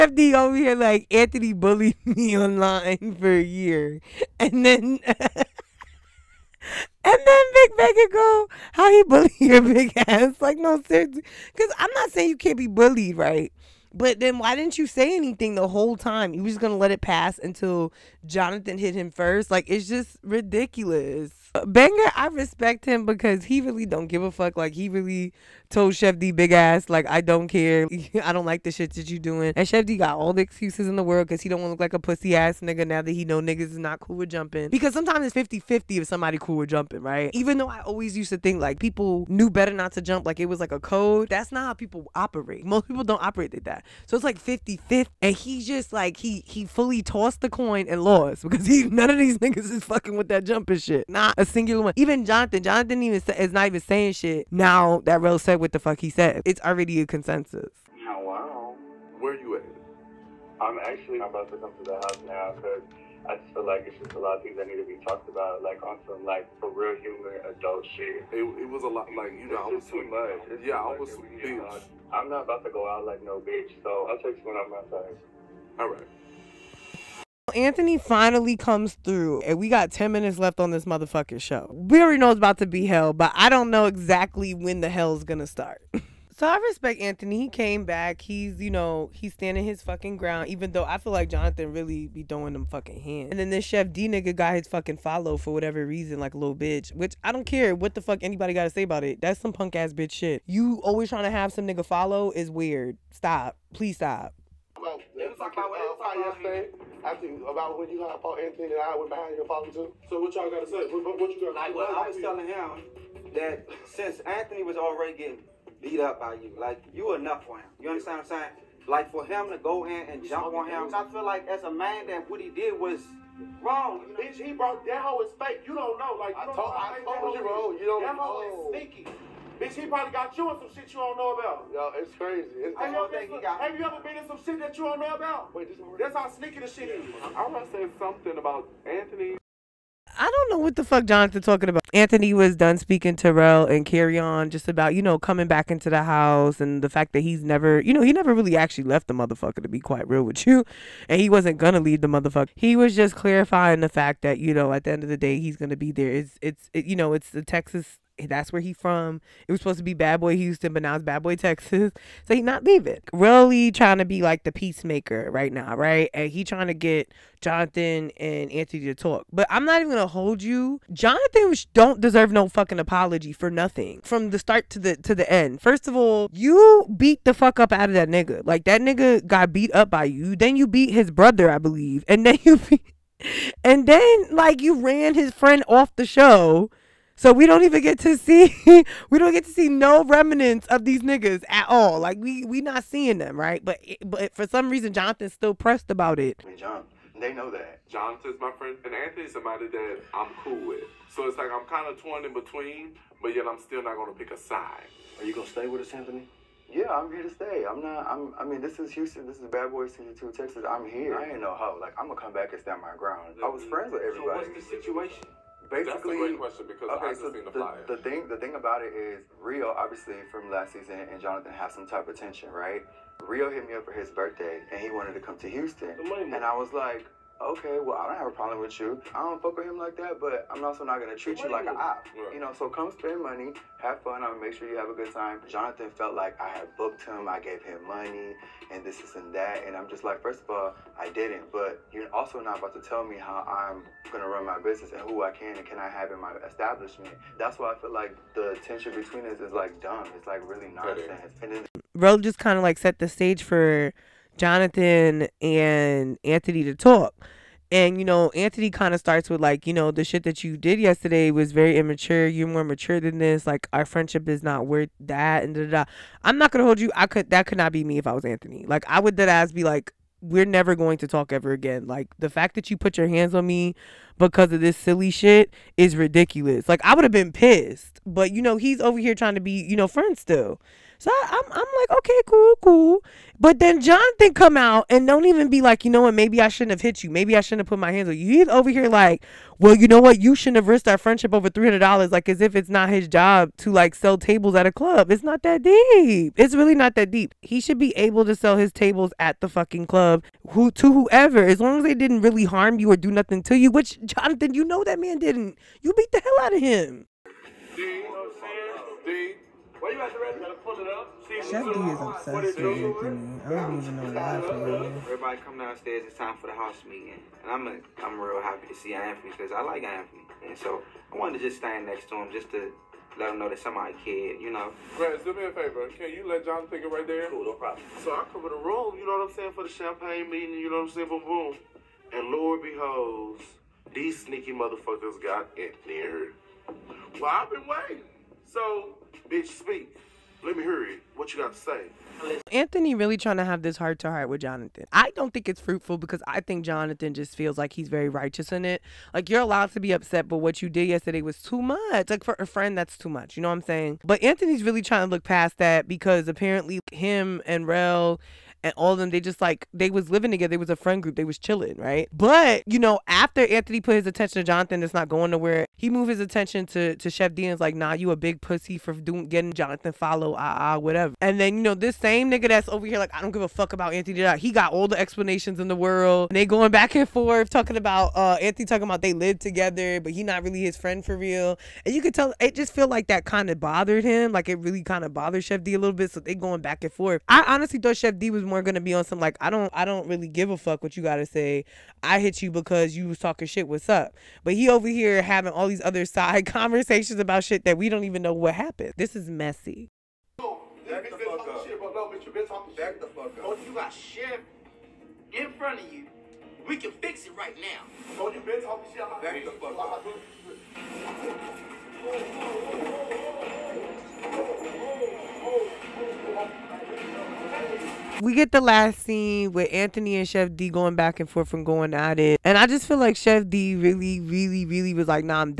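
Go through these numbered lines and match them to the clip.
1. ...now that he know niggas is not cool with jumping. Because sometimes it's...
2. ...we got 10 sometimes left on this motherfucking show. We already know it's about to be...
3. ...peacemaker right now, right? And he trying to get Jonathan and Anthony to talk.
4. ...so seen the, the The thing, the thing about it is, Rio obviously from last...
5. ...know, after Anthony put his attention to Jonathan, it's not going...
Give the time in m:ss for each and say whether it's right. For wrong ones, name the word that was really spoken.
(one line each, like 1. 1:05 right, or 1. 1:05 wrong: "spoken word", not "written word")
1. 0:32 right
2. 1:19 wrong: "minutes", not "sometimes"
3. 2:44 right
4. 3:37 right
5. 6:02 right.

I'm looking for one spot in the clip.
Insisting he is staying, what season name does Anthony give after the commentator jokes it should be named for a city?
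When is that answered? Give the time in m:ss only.
2:41.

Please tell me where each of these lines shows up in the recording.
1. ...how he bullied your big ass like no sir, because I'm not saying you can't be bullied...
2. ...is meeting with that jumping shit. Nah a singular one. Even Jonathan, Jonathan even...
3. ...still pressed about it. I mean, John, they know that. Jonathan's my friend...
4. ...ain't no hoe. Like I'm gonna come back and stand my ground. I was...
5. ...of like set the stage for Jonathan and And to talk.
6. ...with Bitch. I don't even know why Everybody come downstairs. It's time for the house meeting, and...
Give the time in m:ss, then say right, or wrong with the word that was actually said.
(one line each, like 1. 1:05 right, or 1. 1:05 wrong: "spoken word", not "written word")
1. 0:08 right
2. 0:49 wrong: "fucking", not "meeting"
3. 3:15 right
4. 3:31 right
5. 4:12 wrong: "Anthony", not "And"
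6. 5:11 wrong: "Anthony", not "Bitch".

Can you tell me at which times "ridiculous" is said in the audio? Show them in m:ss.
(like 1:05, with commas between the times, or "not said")
0:20, 4:35.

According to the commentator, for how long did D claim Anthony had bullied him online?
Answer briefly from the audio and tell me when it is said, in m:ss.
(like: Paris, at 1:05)
a year, at 0:03.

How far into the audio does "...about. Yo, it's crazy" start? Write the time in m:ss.
2:11.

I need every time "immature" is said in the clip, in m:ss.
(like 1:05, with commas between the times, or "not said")
4:21.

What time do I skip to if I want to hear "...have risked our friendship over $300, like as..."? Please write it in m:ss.
4:50.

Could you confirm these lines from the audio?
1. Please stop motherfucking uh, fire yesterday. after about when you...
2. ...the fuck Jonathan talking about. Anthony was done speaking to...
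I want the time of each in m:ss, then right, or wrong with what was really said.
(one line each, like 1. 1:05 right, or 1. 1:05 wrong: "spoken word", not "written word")
1. 1:43 wrong: "fucking", not "motherfucking"
2. 2:20 right.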